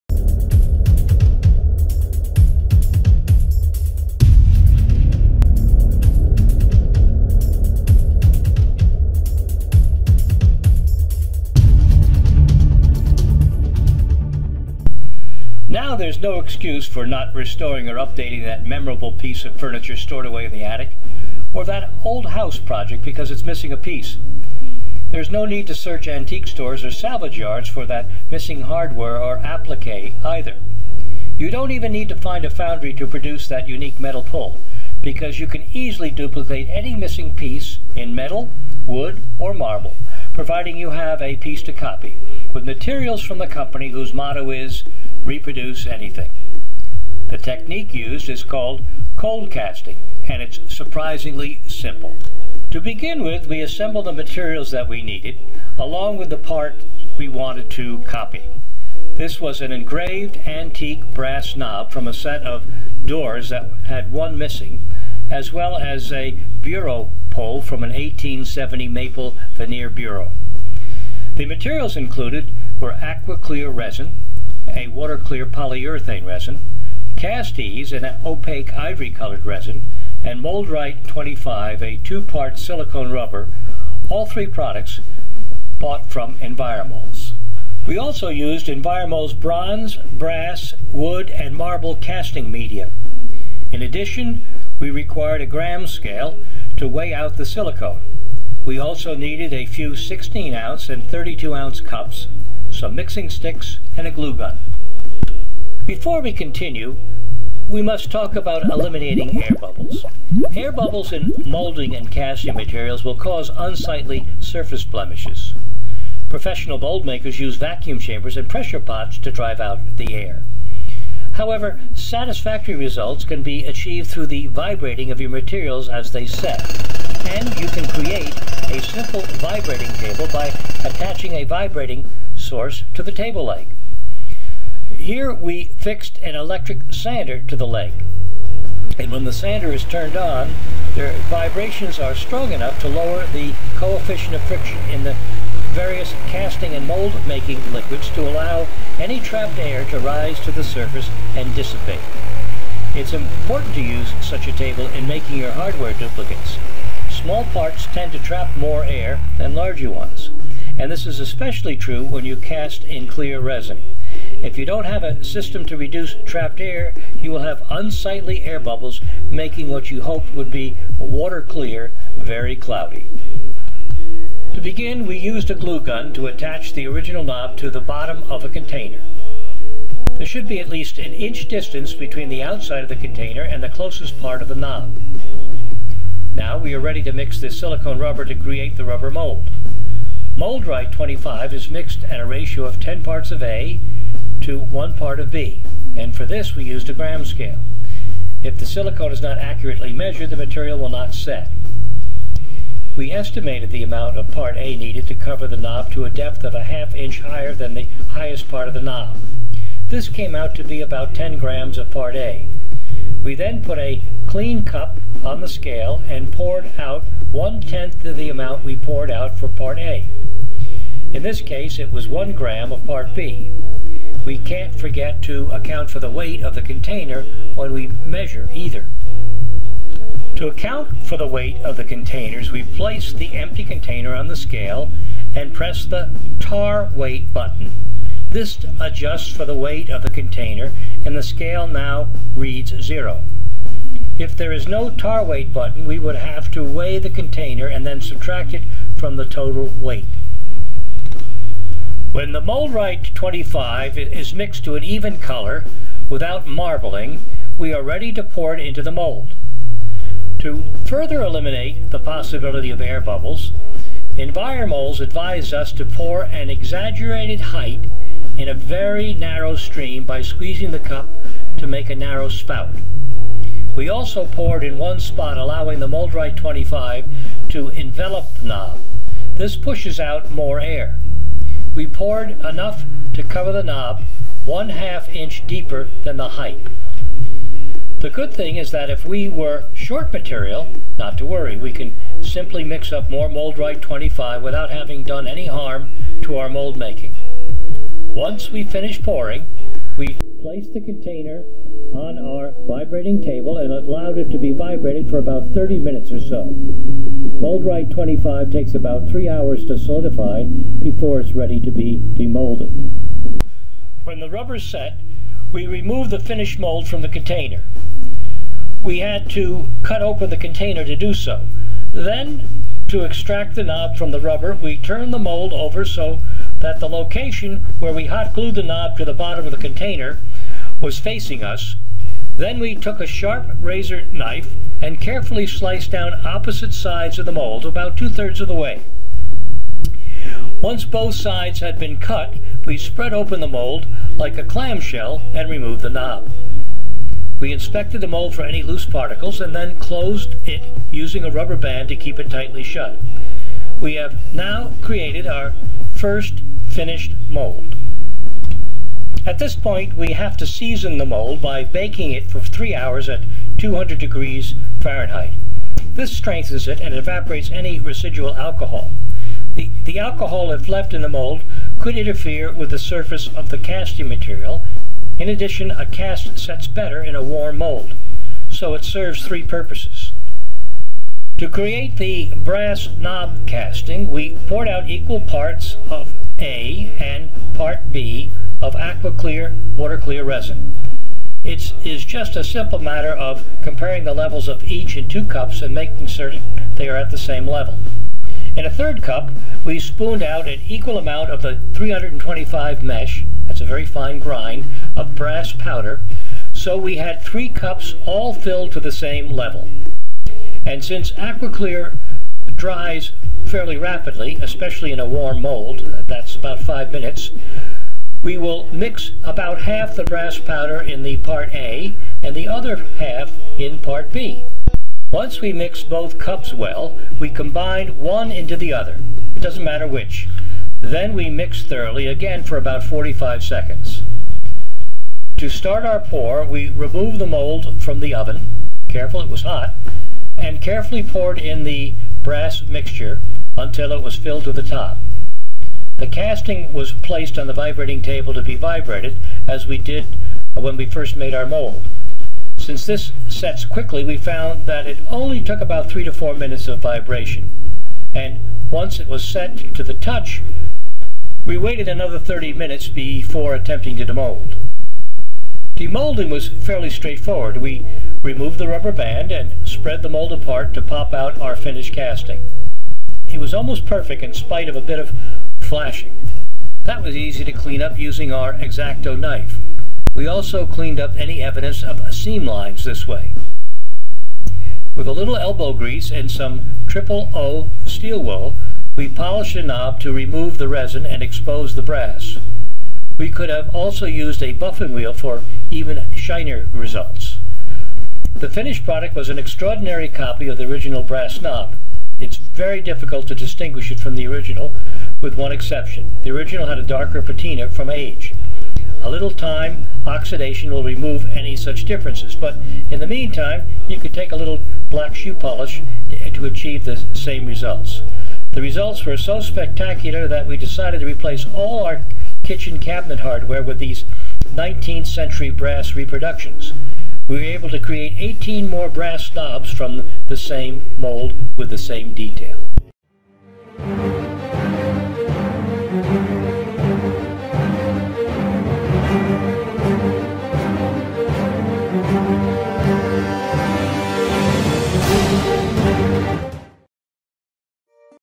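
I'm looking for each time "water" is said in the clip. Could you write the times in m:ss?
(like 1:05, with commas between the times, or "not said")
1:14, 2:50, 6:29.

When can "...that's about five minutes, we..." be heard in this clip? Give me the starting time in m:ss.
6:56.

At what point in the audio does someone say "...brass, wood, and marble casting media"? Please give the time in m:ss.
1:29.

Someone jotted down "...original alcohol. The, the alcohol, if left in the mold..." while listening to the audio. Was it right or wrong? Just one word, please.
wrong.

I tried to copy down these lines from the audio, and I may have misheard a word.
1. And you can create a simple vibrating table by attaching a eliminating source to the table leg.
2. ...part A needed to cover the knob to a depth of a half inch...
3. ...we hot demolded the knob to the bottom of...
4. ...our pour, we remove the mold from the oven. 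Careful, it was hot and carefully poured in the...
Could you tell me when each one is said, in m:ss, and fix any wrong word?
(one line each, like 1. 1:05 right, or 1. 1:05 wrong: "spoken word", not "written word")
1. 2:07 wrong: "vibrating", not "eliminating"
2. 3:24 right
3. 5:27 wrong: "glued", not "demolded"
4. 7:15 right.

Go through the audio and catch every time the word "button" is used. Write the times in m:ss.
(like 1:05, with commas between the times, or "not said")
3:57, 4:05.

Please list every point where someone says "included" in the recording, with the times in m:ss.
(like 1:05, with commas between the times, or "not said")
1:11.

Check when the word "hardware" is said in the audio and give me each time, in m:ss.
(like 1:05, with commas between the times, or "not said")
0:28, 2:35, 8:43.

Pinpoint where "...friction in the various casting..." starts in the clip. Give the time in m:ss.
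2:24.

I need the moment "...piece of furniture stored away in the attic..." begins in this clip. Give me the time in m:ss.
0:19.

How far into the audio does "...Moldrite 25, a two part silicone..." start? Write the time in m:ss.
1:20.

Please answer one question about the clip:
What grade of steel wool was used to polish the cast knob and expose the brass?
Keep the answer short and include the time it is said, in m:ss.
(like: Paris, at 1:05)
Triple O, at 8:06.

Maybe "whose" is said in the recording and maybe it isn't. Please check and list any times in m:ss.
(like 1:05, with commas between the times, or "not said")
0:43.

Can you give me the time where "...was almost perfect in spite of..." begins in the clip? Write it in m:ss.
7:53.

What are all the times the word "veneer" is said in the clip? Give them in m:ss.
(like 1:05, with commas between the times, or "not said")
1:09.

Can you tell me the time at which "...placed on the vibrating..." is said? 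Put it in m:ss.
7:26.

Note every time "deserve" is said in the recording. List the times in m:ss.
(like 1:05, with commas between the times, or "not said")
not said.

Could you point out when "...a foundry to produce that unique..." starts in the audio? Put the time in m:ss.
0:32.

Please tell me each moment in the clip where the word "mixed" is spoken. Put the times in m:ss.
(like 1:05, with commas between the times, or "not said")
3:11, 4:14.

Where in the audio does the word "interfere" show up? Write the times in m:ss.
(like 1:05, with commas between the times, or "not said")
6:11.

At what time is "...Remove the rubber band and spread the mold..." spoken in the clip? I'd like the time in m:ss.
7:48.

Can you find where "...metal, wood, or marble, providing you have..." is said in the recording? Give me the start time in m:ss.
0:38.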